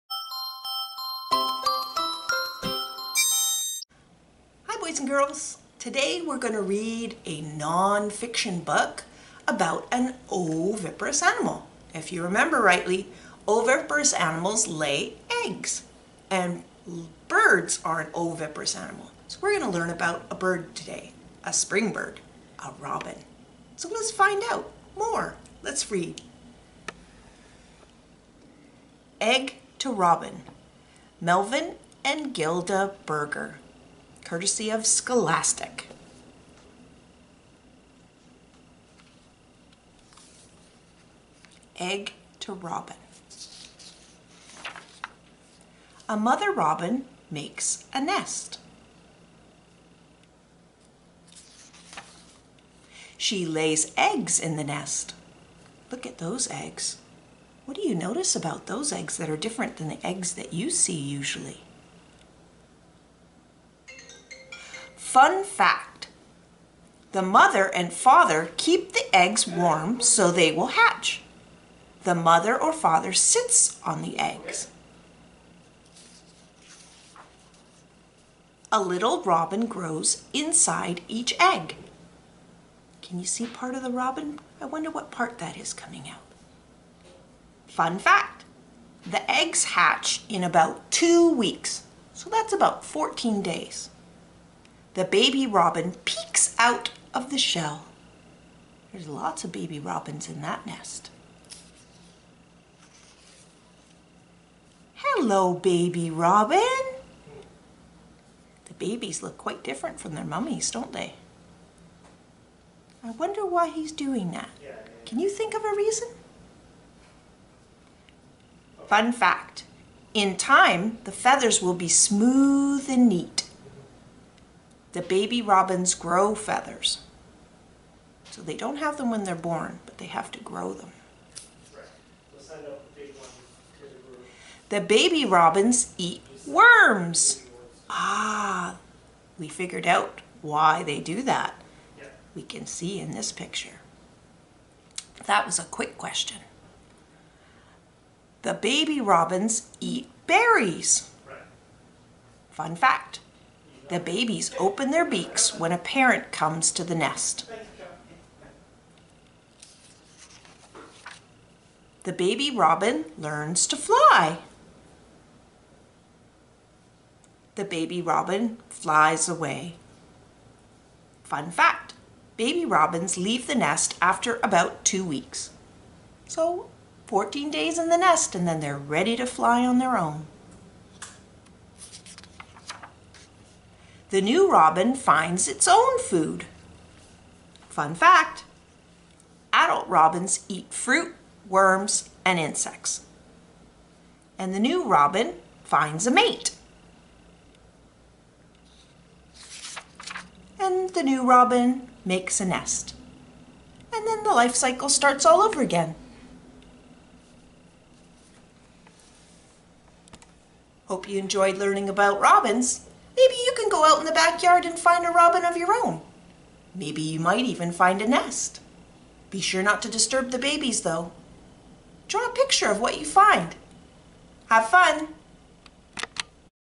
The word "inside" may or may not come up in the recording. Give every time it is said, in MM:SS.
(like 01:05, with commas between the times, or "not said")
01:20.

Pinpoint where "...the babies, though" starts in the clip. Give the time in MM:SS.
03:40.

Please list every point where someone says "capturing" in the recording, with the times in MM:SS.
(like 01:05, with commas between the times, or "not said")
not said.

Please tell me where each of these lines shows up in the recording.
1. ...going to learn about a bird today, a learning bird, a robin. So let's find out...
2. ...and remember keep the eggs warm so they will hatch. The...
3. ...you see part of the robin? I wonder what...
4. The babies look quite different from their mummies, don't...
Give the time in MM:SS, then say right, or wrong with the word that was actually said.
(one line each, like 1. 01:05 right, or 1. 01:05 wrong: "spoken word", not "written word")
1. 00:19 wrong: "spring", not "learning"
2. 01:07 wrong: "father", not "remember"
3. 01:23 right
4. 01:48 right.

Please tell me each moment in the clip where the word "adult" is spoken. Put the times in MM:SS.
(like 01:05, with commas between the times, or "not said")
03:09.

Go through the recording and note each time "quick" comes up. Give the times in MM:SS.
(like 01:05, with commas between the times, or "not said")
02:25.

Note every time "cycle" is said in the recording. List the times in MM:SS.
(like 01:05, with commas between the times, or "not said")
03:24.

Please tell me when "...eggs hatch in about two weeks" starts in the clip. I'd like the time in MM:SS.
01:29.